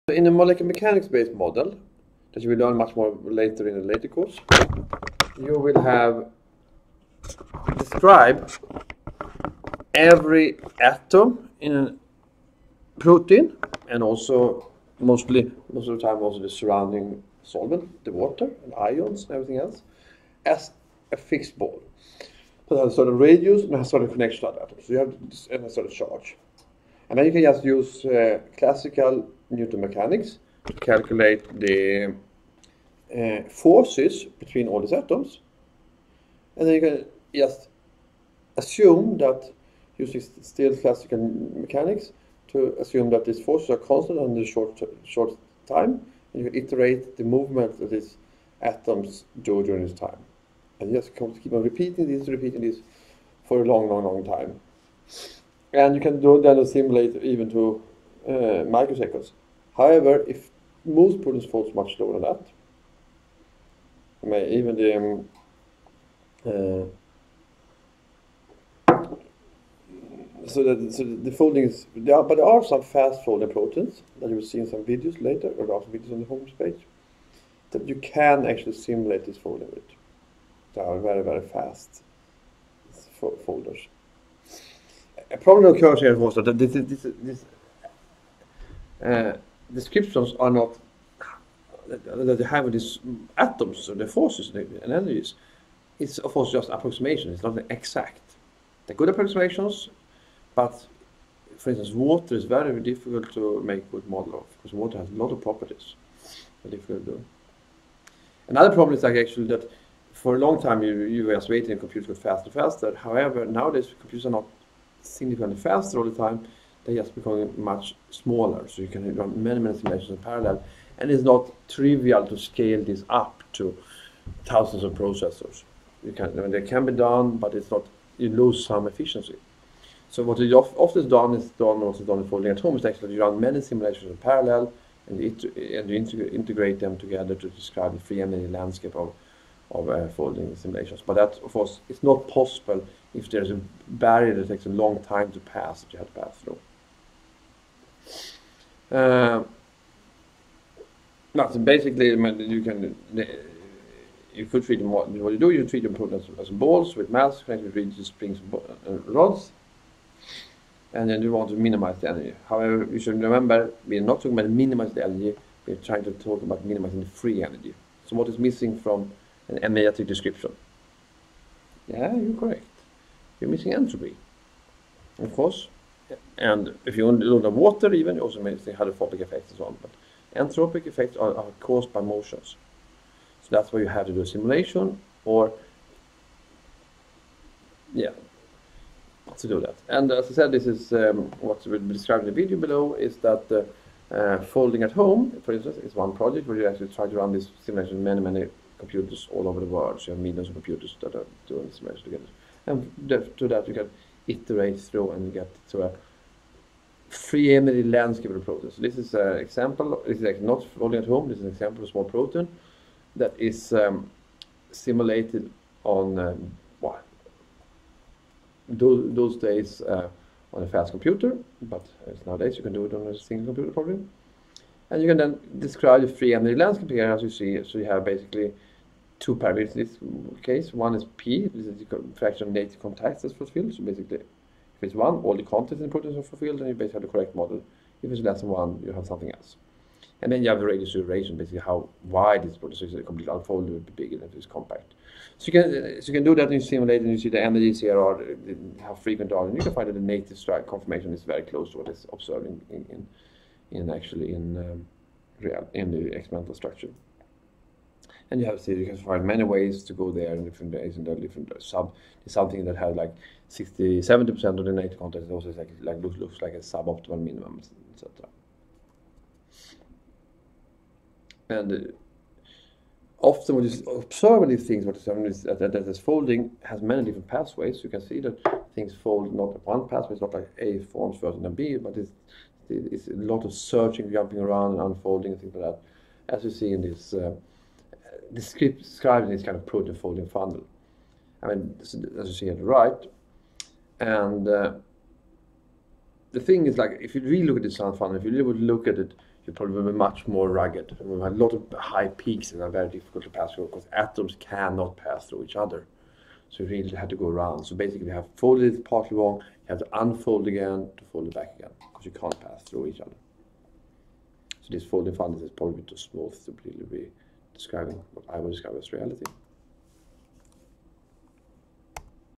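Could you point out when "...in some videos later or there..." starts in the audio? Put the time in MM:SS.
01:14.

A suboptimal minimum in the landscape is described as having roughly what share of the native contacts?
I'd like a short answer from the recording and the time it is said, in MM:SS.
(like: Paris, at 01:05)
60-70 percent, at 04:23.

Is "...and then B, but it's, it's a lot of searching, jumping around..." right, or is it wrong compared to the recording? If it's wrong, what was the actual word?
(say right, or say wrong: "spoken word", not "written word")
right.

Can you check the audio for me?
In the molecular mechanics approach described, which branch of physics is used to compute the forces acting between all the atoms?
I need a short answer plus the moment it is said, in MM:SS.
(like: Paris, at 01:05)
classical Newton mechanics, at 00:28.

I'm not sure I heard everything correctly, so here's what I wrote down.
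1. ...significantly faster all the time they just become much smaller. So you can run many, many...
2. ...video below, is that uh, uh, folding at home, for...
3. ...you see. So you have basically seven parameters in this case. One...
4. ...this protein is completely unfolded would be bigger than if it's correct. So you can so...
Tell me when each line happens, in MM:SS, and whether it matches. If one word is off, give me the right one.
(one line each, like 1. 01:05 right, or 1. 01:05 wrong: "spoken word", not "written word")
1. 01:55 right
2. 03:12 right
3. 03:47 wrong: "two", not "seven"
4. 04:02 wrong: "compact", not "correct".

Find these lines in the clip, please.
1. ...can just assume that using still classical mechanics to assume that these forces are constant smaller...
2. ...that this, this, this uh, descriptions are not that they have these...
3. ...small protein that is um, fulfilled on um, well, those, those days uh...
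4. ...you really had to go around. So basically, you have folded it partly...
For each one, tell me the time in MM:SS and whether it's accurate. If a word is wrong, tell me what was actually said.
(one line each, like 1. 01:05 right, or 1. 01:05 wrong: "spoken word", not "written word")
1. 00:36 wrong: "under", not "smaller"
2. 01:26 right
3. 03:31 wrong: "simulated", not "fulfilled"
4. 05:06 right.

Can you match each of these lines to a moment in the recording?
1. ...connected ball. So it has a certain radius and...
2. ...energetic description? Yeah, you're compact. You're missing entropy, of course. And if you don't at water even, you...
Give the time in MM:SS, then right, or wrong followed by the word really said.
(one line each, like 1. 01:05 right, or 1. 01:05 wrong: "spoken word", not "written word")
1. 00:21 wrong: "fixed", not "connected"
2. 02:49 wrong: "correct", not "compact".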